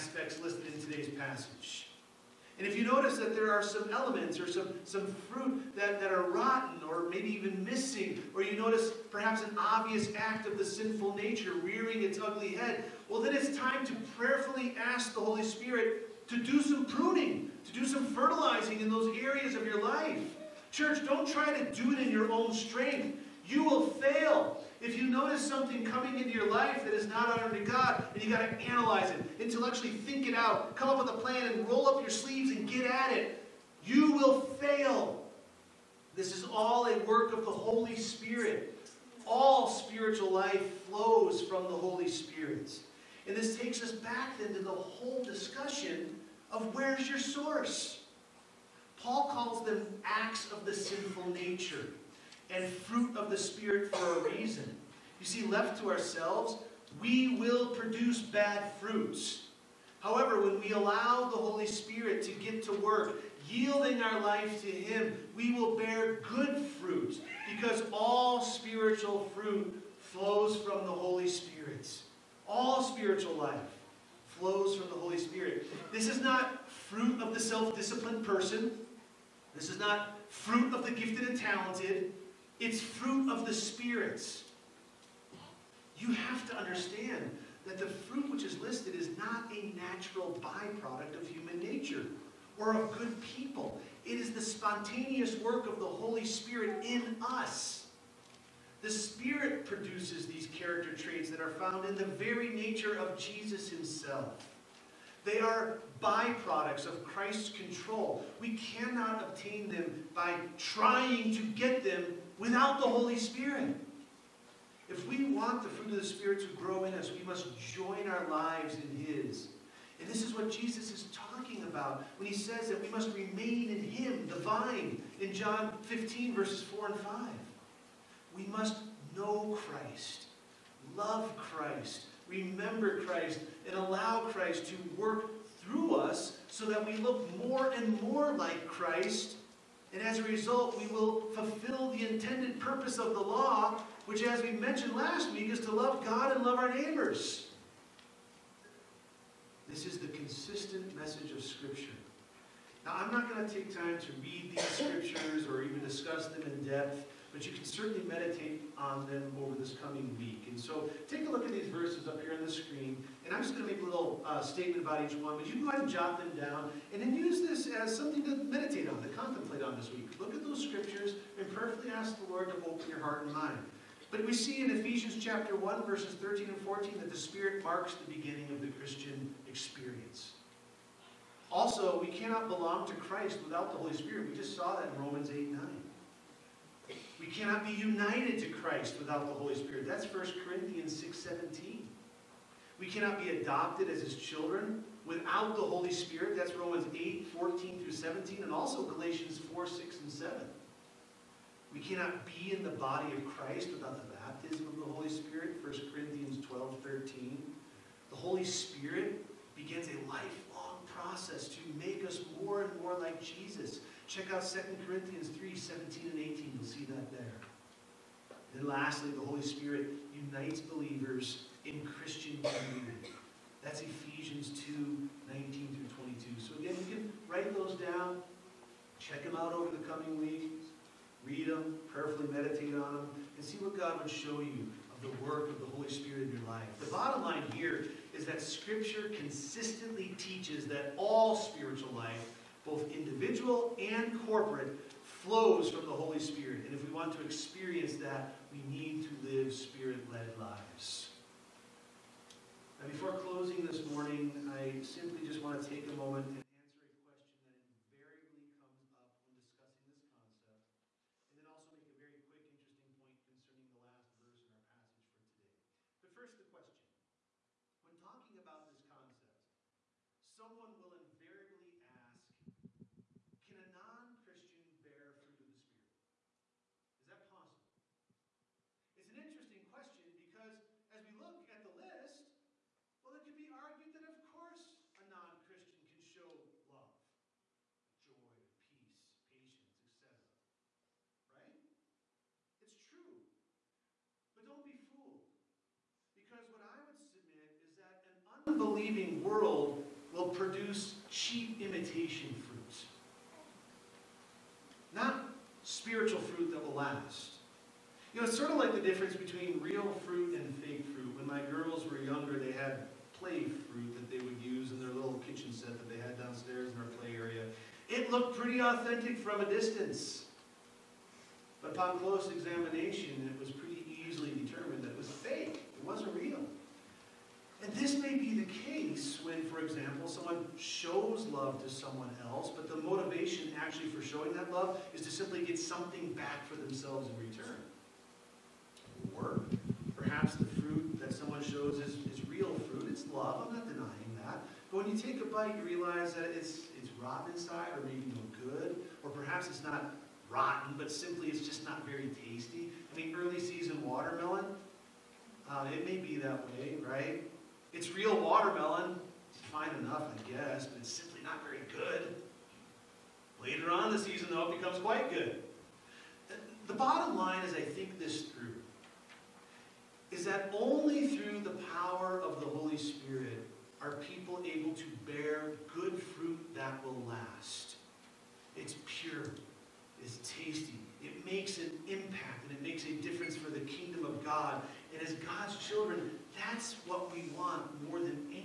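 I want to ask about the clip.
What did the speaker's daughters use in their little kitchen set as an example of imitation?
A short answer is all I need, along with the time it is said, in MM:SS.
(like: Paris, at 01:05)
Play fruit, at 05:13.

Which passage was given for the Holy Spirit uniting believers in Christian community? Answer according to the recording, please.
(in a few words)
Ephesians 2:19-22.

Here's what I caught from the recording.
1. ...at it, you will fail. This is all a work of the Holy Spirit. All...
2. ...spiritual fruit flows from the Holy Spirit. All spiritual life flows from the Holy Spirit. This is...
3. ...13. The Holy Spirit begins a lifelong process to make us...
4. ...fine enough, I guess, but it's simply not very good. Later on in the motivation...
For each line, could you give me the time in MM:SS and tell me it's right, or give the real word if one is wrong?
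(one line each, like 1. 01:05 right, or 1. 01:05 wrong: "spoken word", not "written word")
1. 00:32 right
2. 01:08 right
3. 03:26 right
4. 05:59 wrong: "season", not "motivation".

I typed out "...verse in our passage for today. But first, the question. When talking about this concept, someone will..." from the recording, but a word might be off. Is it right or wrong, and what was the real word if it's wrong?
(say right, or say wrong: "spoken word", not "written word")
right.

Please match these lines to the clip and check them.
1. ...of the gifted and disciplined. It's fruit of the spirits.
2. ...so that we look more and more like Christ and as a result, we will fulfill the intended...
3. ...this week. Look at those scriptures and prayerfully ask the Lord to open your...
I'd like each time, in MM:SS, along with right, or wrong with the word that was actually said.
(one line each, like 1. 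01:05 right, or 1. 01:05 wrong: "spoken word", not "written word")
1. 01:20 wrong: "talented", not "disciplined"
2. 02:16 right
3. 02:49 right.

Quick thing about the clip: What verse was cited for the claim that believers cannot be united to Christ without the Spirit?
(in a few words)
1 Corinthians 6:17.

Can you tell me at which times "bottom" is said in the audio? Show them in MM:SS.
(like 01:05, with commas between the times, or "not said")
03:56, 06:06.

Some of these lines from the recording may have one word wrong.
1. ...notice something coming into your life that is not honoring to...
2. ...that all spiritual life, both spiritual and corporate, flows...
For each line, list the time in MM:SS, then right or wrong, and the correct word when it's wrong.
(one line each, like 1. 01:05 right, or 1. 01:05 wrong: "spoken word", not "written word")
1. 00:25 right
2. 04:00 wrong: "individual", not "spiritual".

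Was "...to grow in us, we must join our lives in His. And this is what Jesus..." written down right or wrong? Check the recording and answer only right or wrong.
right.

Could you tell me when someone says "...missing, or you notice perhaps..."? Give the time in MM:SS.
00:07.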